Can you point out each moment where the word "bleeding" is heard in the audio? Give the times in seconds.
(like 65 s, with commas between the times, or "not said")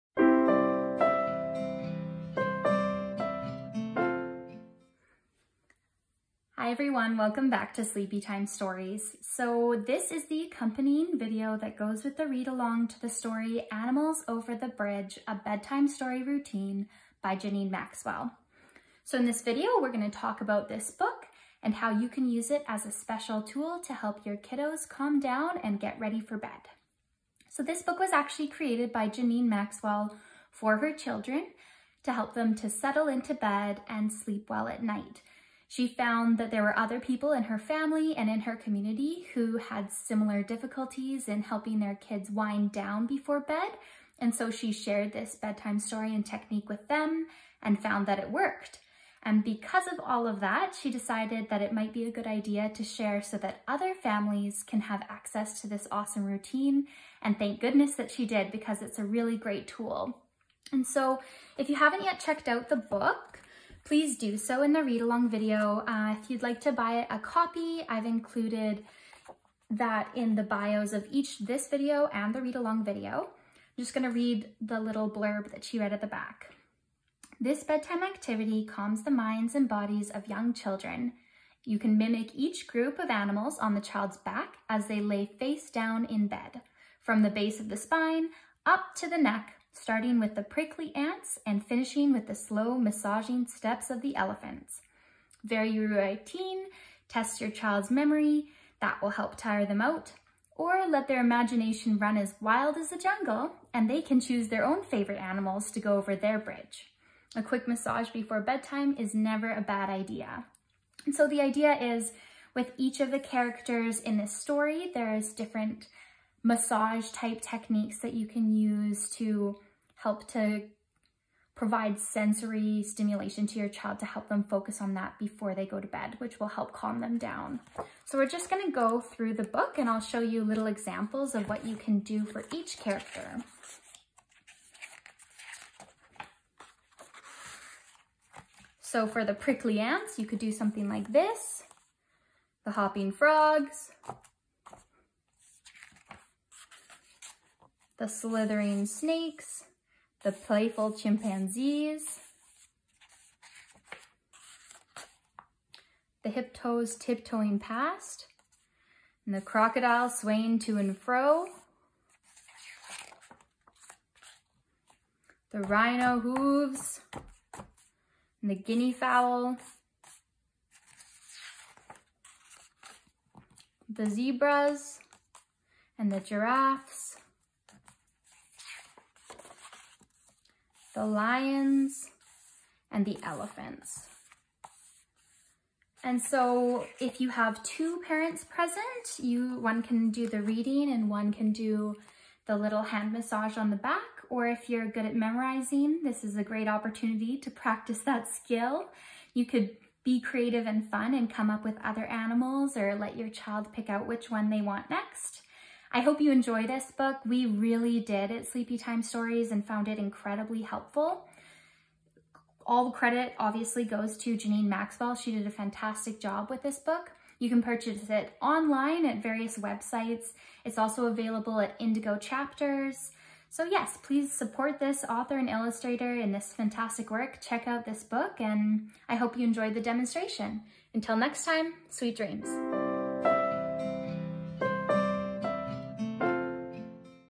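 not said.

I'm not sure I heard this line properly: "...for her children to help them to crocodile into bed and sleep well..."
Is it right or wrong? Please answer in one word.
wrong.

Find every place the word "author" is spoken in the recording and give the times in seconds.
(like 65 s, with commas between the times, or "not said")
225 s.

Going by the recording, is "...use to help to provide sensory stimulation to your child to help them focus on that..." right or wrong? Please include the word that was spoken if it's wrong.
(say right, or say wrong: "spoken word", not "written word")
right.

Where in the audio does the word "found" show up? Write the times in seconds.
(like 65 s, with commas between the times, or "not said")
35 s, 47 s, 209 s.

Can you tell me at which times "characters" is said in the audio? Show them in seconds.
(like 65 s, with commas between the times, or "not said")
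113 s, 132 s.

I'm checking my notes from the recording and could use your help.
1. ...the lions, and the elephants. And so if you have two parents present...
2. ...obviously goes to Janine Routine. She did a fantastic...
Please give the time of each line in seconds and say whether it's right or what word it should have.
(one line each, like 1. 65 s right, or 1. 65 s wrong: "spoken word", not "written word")
1. 180 s right
2. 213 s wrong: "Maxwell", not "Routine".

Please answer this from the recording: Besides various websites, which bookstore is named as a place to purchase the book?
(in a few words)
Indigo Chapters.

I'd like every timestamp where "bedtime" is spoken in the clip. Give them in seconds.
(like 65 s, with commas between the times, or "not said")
15 s, 45 s, 77 s, 108 s.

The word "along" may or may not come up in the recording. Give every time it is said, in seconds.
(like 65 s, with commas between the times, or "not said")
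12 s, 65 s, 72 s.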